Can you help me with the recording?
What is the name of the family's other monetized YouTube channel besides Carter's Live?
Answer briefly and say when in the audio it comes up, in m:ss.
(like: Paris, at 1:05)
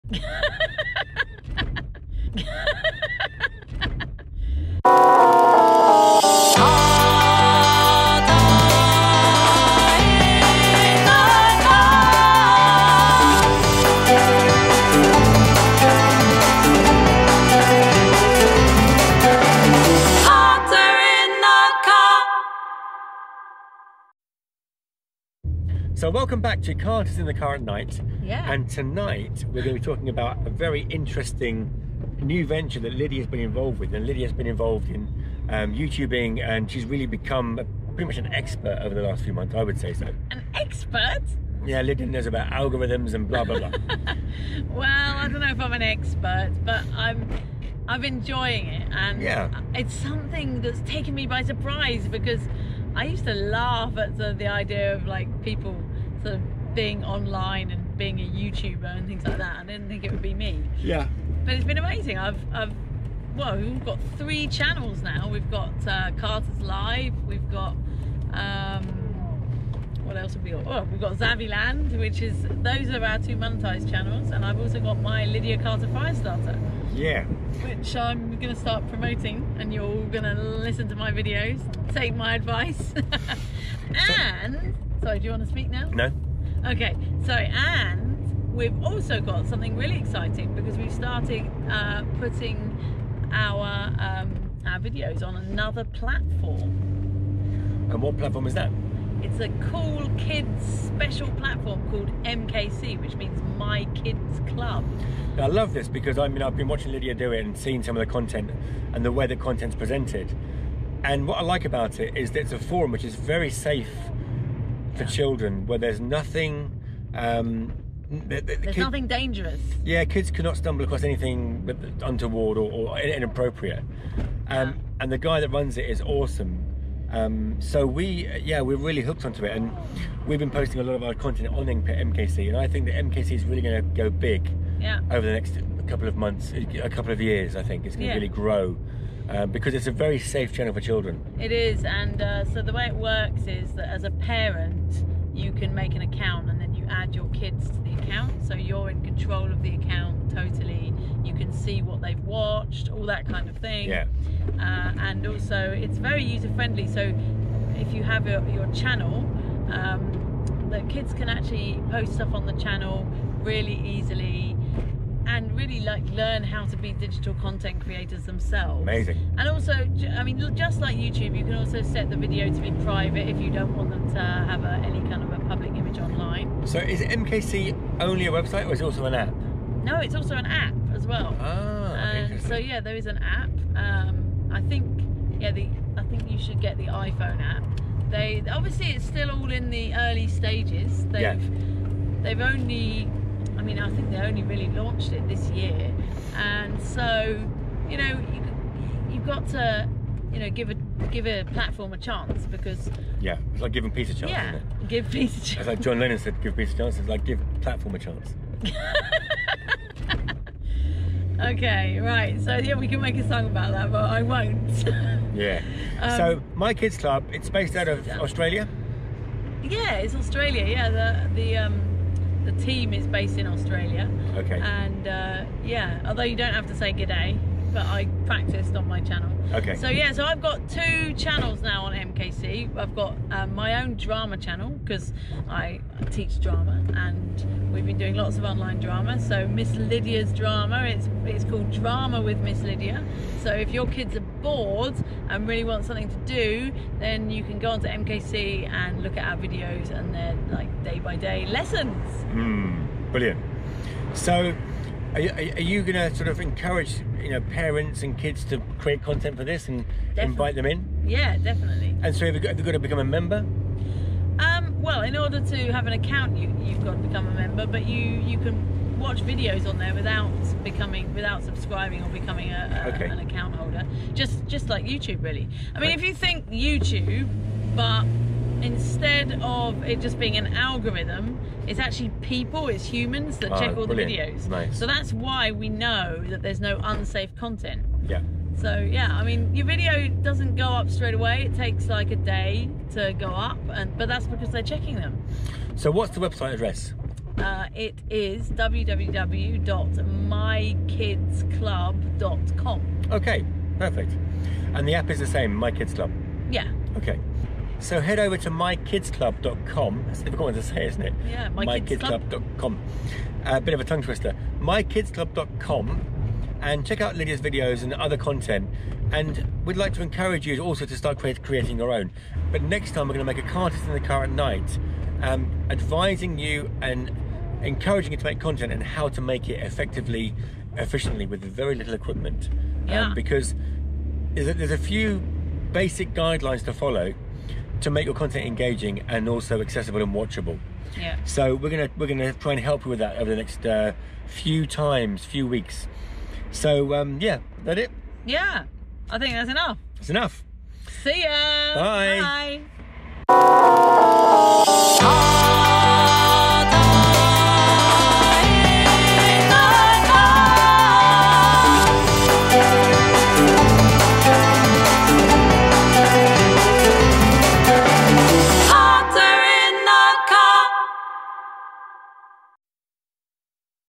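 Zaviland, at 1:11.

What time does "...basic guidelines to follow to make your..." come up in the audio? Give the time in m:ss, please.
5:35.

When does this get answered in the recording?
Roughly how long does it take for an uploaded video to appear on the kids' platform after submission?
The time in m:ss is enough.
4:52.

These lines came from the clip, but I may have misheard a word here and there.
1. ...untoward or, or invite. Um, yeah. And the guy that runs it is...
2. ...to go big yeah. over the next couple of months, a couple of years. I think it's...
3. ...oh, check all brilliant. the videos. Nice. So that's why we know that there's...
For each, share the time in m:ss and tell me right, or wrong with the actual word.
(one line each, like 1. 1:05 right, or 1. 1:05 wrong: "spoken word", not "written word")
1. 2:02 wrong: "inappropriate", not "invite"
2. 2:13 right
3. 4:43 right.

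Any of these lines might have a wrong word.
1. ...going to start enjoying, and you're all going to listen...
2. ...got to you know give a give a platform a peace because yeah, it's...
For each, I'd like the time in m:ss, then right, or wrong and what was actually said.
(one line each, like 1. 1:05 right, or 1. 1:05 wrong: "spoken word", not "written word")
1. 1:18 wrong: "promoting", not "enjoying"
2. 3:19 wrong: "chance", not "peace".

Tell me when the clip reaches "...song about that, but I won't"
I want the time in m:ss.
3:33.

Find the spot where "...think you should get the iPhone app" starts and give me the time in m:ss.
3:06.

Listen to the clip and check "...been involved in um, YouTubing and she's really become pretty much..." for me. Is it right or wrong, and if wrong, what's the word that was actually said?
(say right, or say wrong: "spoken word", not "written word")
right.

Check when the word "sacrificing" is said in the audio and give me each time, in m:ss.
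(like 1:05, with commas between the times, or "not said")
not said.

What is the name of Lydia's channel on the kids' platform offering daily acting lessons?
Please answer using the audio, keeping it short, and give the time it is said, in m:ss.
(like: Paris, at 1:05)
Drama with Miss Lydia, at 4:01.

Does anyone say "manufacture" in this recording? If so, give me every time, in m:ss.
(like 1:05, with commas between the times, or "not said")
not said.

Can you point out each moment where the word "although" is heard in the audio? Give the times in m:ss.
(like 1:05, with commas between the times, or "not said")
3:46.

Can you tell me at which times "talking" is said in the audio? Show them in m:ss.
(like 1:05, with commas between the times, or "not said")
0:29.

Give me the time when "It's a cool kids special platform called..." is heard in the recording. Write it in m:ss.
1:39.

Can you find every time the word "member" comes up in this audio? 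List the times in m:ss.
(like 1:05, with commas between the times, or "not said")
4:23, 4:27.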